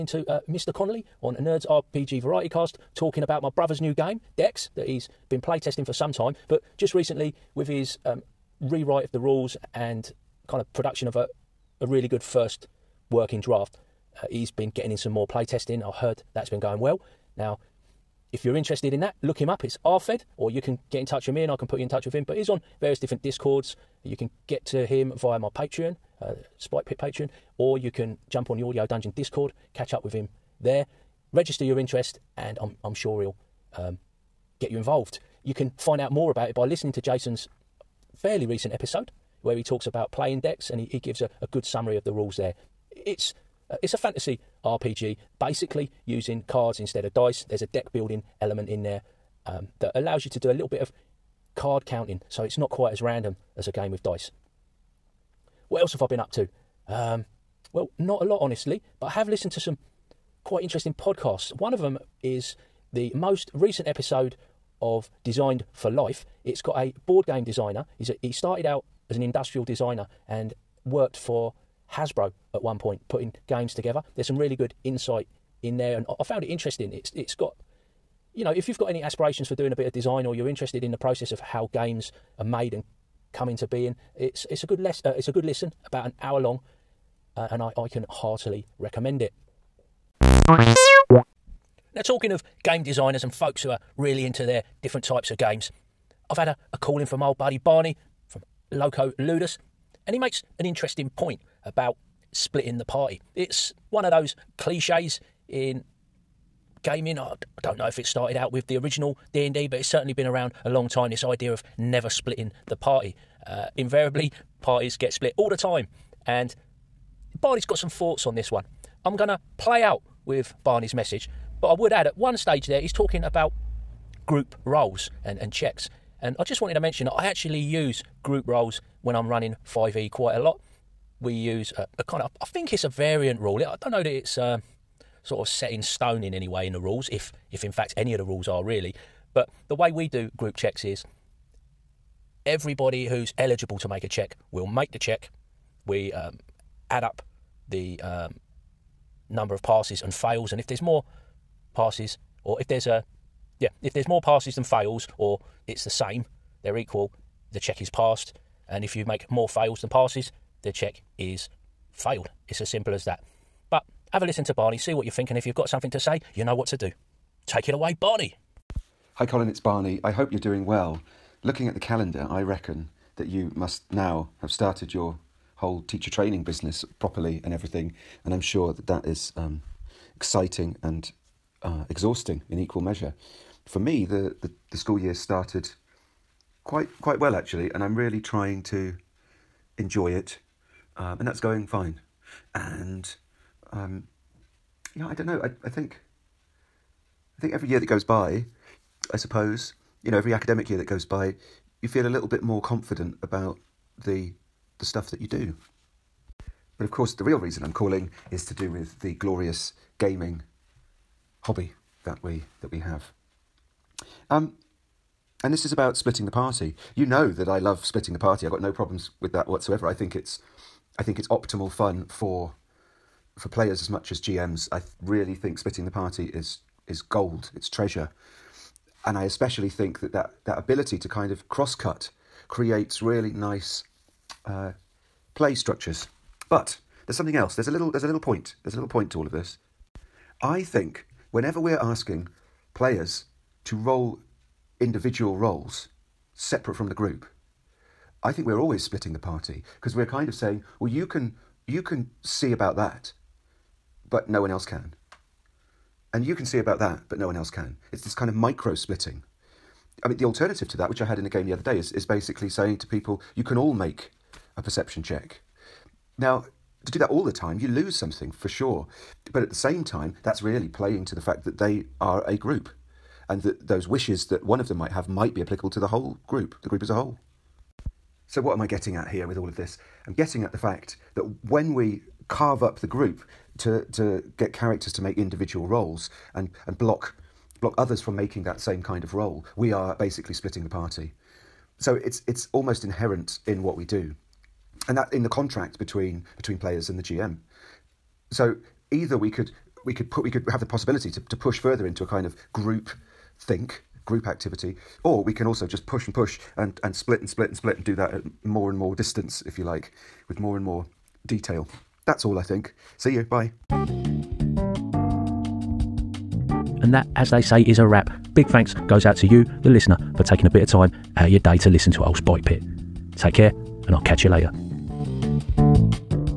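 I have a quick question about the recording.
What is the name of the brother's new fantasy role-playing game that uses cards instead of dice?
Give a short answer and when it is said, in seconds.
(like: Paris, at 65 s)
Dex, at 4 s.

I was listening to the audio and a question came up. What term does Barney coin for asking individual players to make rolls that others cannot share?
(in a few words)
Micro splitting.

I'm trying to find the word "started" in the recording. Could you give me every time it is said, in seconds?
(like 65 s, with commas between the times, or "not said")
68 s, 108 s, 174 s, 185 s.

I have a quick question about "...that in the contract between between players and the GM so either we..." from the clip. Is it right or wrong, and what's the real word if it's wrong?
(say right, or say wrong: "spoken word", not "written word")
right.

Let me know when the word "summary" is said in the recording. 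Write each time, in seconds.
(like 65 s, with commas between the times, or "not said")
41 s.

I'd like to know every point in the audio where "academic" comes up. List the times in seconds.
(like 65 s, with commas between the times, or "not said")
200 s.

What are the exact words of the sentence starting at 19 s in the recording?
It's RFed, or you can get in touch with me and I can put you in touch with him.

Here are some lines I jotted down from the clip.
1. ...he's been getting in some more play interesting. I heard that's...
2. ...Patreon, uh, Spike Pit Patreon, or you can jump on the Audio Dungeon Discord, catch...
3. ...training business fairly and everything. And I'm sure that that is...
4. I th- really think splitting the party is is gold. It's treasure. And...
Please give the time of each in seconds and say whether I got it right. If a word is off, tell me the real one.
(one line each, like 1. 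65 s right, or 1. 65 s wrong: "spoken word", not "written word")
1. 14 s wrong: "testing", not "interesting"
2. 25 s right
3. 176 s wrong: "properly", not "fairly"
4. 224 s right.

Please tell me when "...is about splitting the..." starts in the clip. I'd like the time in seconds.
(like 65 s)
215 s.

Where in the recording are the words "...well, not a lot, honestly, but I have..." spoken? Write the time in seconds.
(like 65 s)
57 s.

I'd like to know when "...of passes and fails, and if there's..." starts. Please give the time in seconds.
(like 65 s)
149 s.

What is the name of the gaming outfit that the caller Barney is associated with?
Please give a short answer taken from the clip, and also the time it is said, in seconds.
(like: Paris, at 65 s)
Loco Ludus, at 98 s.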